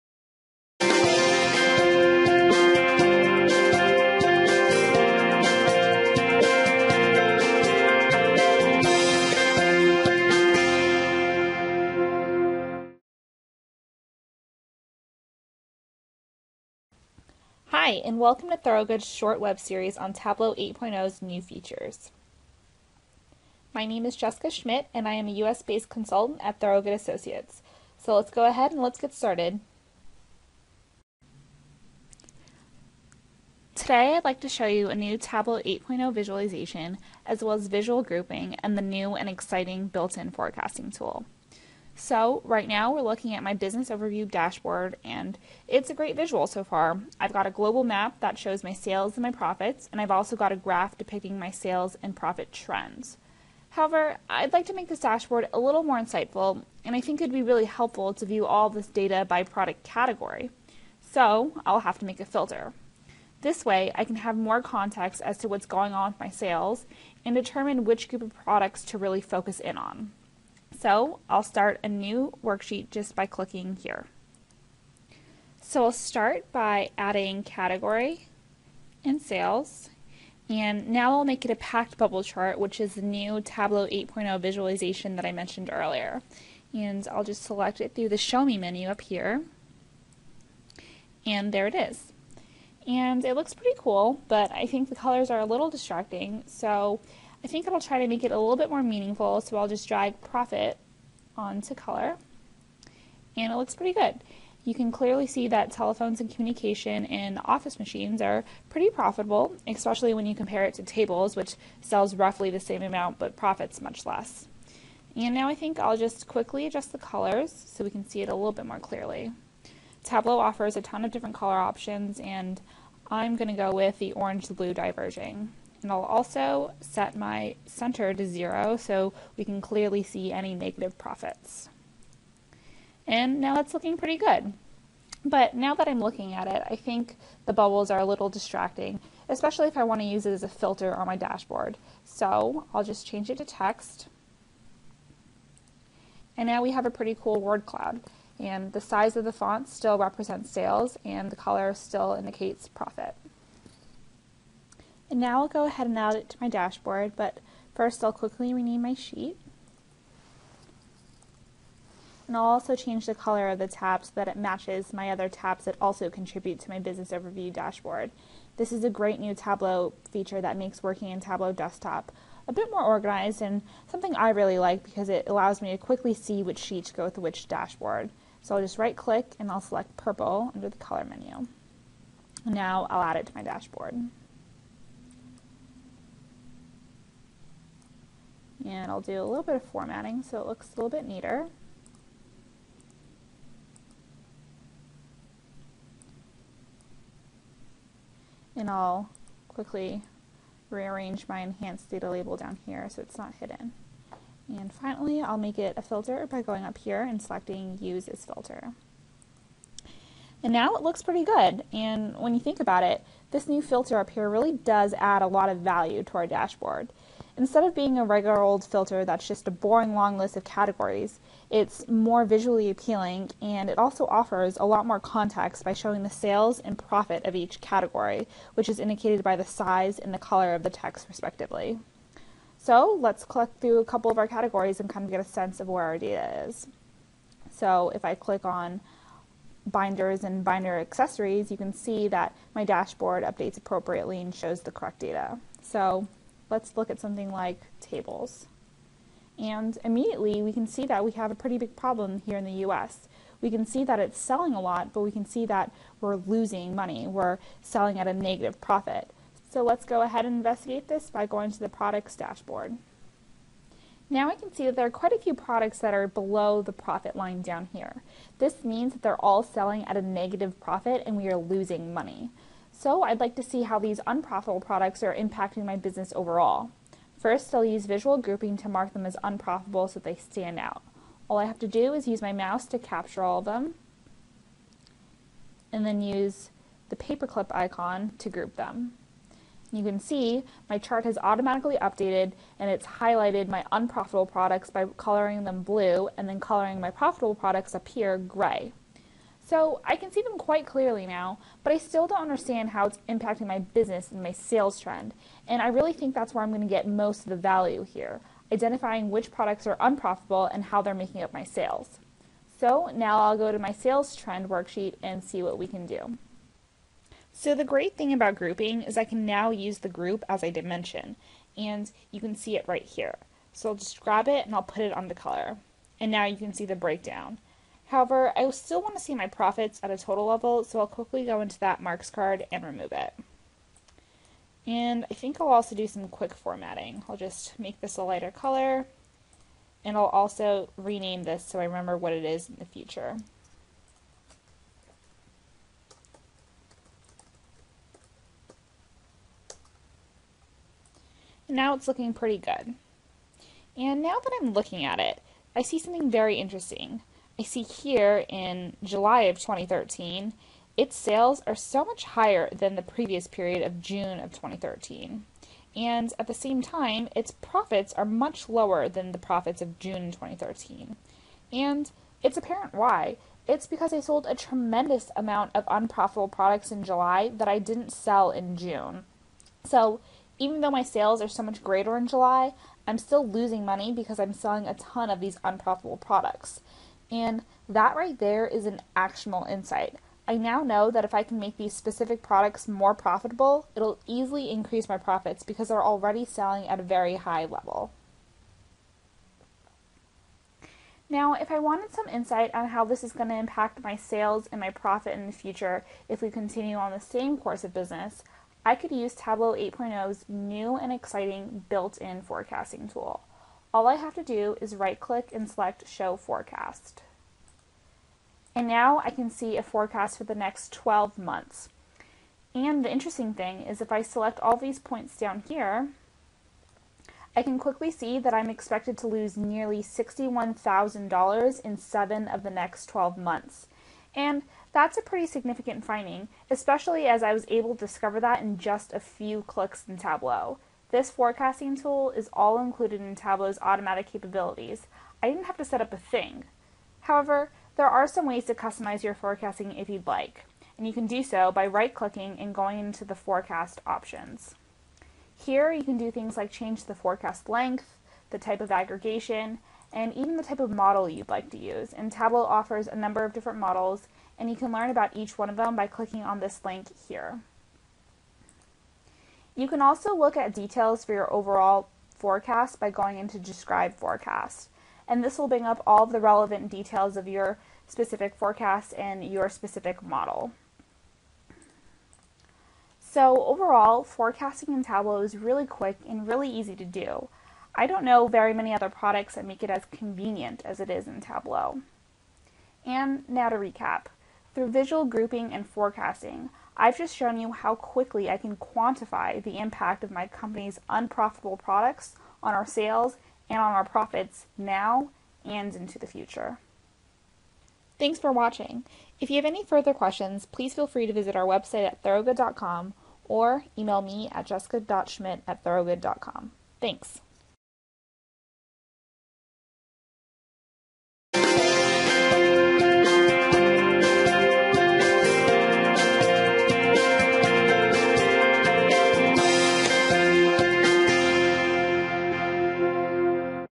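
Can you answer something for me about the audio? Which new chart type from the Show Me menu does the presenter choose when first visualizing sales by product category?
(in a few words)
Packed bubble chart.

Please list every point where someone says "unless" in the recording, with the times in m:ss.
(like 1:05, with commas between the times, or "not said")
not said.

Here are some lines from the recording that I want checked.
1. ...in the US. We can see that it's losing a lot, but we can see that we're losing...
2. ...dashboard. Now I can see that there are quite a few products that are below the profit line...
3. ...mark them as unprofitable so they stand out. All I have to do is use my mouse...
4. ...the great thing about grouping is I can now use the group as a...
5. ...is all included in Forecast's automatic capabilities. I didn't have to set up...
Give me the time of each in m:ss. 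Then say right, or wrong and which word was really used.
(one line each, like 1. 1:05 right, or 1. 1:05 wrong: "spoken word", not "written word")
1. 4:12 wrong: "selling", not "losing"
2. 4:22 right
3. 4:38 right
4. 5:17 right
5. 7:22 wrong: "Tableau", not "Forecast".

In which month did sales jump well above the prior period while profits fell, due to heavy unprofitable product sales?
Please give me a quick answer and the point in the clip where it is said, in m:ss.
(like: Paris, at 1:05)
July 2013, at 5:58.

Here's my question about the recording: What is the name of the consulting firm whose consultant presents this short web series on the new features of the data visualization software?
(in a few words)
Thorogood Associates.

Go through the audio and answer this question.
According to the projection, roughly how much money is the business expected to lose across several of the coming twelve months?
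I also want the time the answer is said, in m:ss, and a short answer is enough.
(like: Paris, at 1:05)
$61,000, at 7:09.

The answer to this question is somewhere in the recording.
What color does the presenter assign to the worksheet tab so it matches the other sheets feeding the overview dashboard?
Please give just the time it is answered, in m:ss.
2:59.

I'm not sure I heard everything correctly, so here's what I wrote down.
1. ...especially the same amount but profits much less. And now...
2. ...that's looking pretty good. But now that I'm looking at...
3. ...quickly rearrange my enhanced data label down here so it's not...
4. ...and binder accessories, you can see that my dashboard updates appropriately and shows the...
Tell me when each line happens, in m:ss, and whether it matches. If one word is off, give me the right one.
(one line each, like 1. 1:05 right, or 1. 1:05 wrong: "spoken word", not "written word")
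1. 1:52 wrong: "roughly", not "especially"
2. 2:13 right
3. 3:19 right
4. 4:00 right.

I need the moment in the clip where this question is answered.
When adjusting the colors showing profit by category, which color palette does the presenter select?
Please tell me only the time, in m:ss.
2:04.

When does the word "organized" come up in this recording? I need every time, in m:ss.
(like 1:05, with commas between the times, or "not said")
2:52.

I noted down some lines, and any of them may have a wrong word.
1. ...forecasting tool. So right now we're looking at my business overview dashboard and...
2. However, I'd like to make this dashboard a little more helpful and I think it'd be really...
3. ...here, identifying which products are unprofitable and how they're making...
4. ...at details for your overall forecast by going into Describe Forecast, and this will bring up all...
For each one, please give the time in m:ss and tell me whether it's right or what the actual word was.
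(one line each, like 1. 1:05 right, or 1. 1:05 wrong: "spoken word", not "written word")
1. 0:40 right
2. 0:53 wrong: "insightful", not "helpful"
3. 5:07 right
4. 7:50 right.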